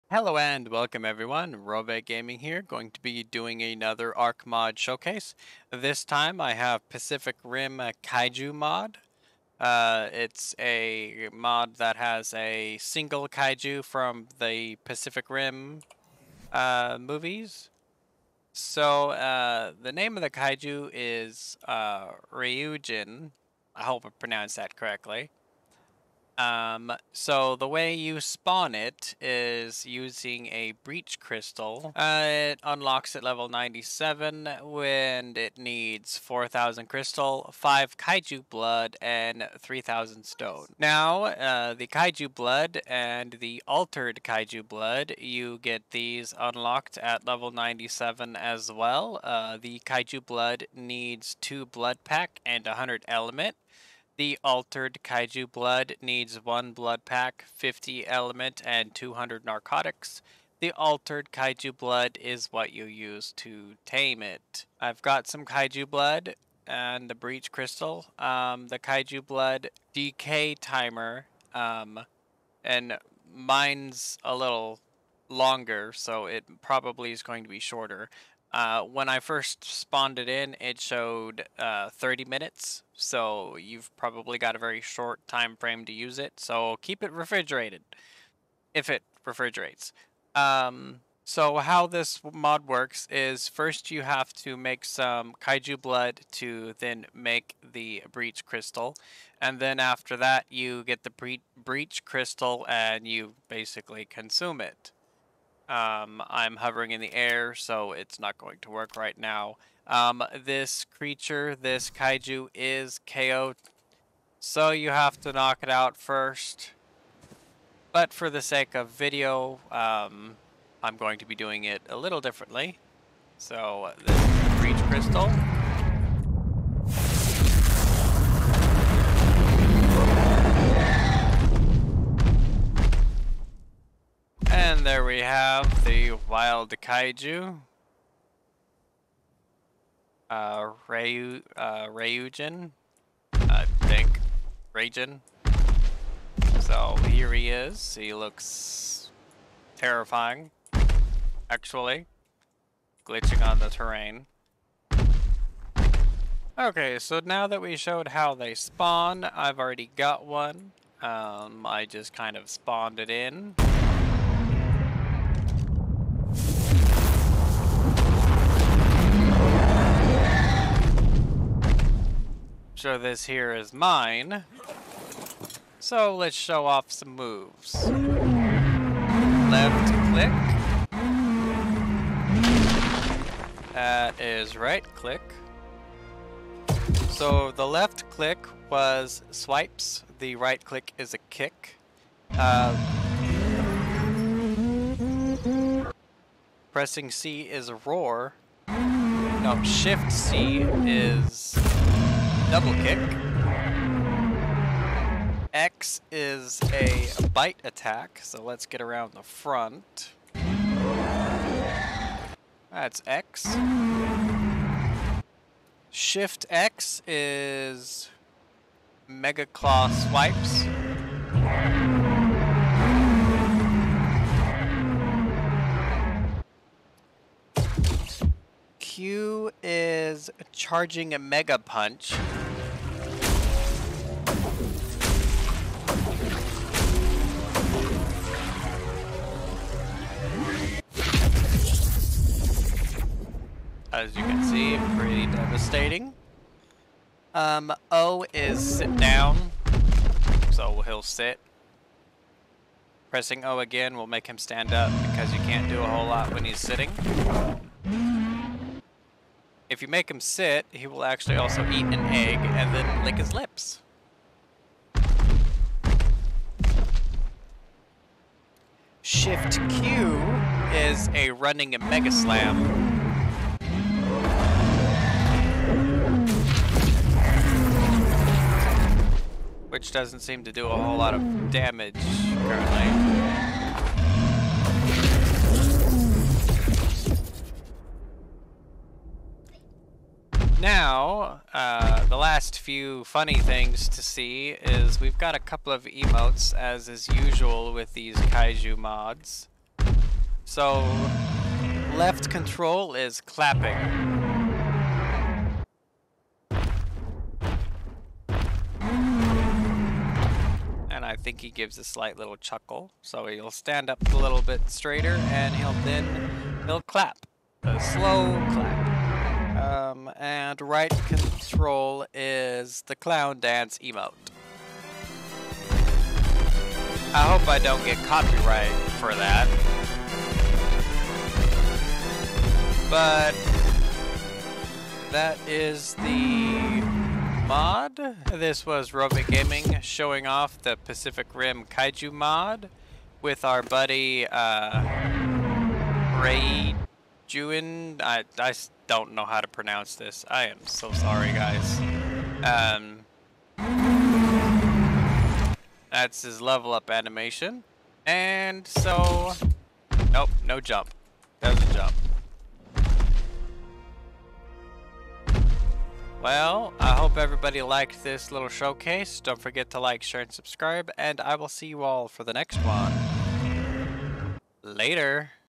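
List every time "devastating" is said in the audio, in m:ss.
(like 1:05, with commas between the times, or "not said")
4:05.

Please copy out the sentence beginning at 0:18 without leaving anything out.
So uh, the name of the kaiju is uh, Ryujin, I hope I pronounced that correctly.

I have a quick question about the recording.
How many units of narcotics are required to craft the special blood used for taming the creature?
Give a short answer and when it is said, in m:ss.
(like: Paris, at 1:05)
200, at 0:58.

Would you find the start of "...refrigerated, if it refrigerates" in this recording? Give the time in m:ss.
1:27.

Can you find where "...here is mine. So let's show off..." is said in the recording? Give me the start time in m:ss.
2:53.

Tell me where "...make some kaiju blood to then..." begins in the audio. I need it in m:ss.
1:34.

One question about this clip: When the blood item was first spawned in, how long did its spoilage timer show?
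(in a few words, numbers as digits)
30 minutes.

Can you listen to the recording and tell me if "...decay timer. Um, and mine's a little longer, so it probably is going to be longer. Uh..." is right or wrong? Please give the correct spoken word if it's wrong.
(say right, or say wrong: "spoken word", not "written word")
wrong: "shorter", not "longer".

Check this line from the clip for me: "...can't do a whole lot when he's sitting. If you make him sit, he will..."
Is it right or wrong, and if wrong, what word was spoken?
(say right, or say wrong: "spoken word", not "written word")
right.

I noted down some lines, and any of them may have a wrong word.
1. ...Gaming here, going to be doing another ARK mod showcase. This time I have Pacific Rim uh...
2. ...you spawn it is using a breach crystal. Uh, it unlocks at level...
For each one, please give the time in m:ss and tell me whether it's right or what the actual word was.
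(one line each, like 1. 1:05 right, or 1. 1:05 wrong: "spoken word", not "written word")
1. 0:02 right
2. 0:27 right.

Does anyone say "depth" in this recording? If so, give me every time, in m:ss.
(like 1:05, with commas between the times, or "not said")
not said.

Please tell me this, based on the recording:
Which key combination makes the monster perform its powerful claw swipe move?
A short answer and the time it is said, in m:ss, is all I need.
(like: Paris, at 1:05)
Shift X, at 3:35.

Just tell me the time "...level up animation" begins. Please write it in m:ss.
5:56.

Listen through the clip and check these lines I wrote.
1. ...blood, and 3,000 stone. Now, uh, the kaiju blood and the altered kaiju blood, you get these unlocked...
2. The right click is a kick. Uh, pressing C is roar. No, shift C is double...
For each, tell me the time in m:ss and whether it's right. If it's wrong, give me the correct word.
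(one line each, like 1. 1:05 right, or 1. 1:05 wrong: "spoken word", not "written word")
1. 0:38 right
2. 3:10 right.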